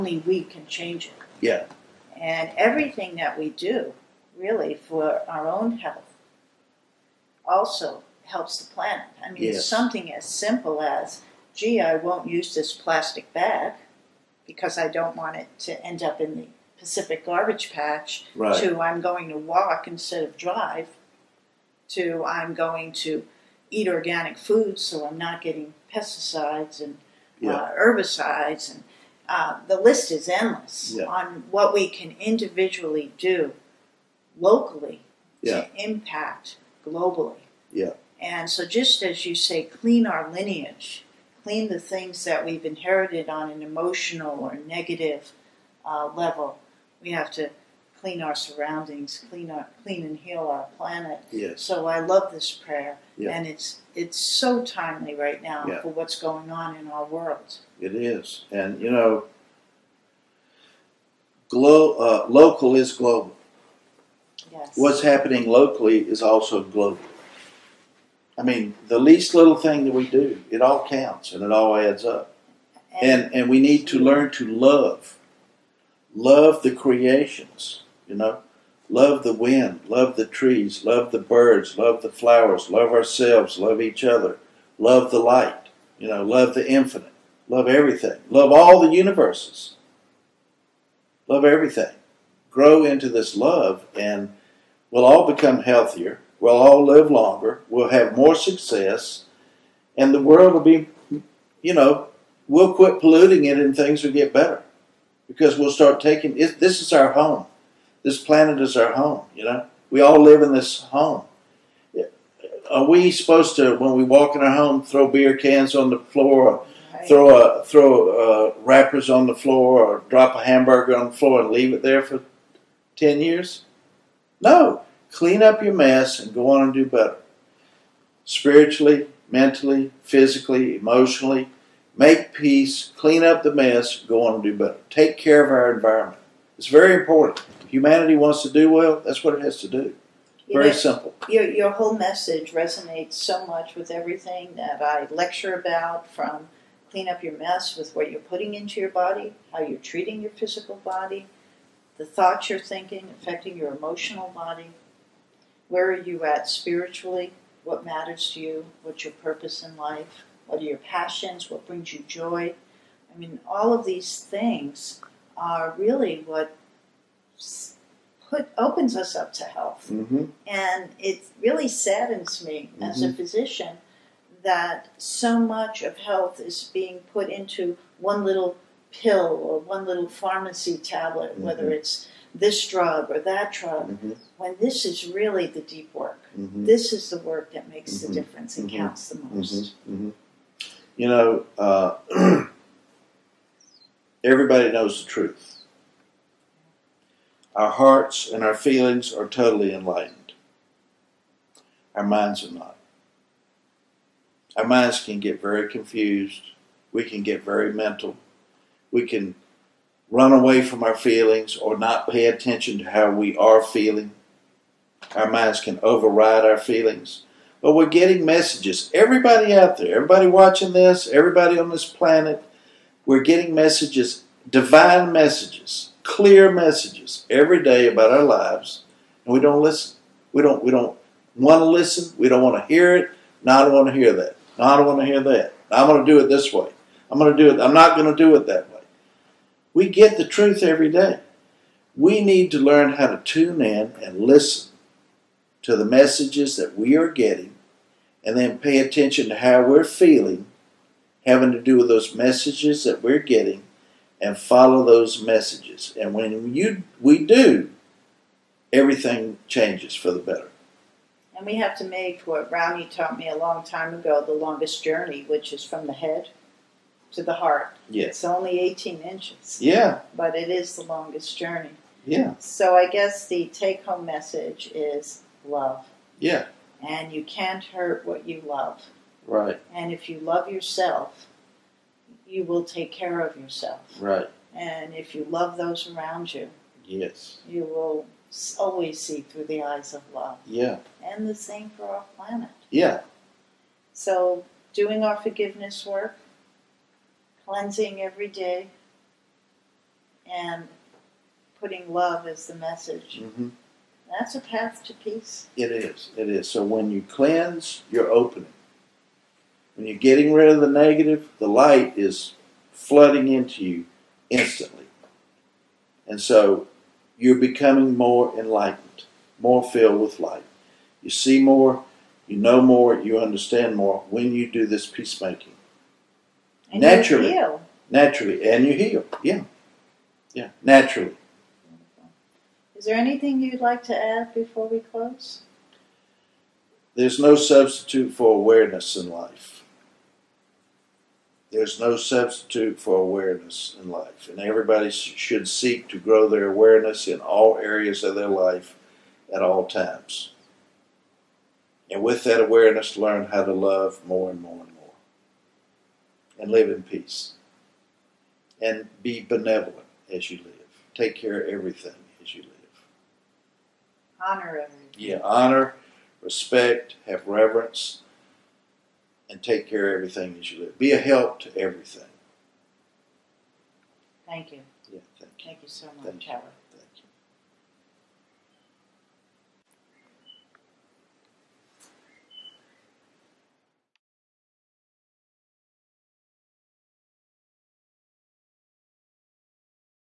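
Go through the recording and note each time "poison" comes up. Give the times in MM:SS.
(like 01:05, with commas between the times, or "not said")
not said.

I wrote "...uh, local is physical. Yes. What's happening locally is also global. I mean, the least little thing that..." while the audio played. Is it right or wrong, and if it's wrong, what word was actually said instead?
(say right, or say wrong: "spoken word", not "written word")
wrong: "global", not "physical".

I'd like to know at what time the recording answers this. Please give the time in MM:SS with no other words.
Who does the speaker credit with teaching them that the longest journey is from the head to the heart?
04:22.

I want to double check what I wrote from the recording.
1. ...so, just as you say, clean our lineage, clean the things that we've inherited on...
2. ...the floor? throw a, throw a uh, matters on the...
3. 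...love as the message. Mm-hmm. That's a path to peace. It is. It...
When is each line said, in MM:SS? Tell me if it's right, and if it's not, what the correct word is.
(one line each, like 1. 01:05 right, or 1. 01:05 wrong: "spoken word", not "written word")
1. 00:38 right
2. 01:55 wrong: "wrappers", not "matters"
3. 05:01 right.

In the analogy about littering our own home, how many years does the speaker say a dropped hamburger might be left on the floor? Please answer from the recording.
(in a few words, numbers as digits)
10.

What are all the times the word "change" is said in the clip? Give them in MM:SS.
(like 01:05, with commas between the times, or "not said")
00:00, 04:19.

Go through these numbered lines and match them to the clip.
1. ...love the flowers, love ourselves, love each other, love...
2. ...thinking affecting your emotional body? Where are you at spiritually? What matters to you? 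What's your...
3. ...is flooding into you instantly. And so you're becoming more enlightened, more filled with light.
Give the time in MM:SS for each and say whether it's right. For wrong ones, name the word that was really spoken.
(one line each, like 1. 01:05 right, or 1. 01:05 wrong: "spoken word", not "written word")
1. 01:21 right
2. 02:32 right
3. 05:11 right.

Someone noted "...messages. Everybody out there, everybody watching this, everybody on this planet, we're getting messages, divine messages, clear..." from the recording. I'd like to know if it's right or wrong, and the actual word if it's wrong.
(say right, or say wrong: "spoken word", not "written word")
right.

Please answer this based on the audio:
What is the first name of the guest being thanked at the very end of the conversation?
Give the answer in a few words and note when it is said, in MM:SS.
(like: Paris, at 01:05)
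Howard, at 06:16.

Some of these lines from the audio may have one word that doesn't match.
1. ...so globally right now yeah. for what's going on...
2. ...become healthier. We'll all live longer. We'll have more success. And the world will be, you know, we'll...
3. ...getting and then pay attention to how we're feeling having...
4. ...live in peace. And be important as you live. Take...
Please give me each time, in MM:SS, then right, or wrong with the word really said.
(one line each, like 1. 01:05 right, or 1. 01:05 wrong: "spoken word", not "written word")
1. 00:54 wrong: "timely", not "globally"
2. 01:35 right
3. 04:07 right
4. 05:56 wrong: "benevolent", not "important".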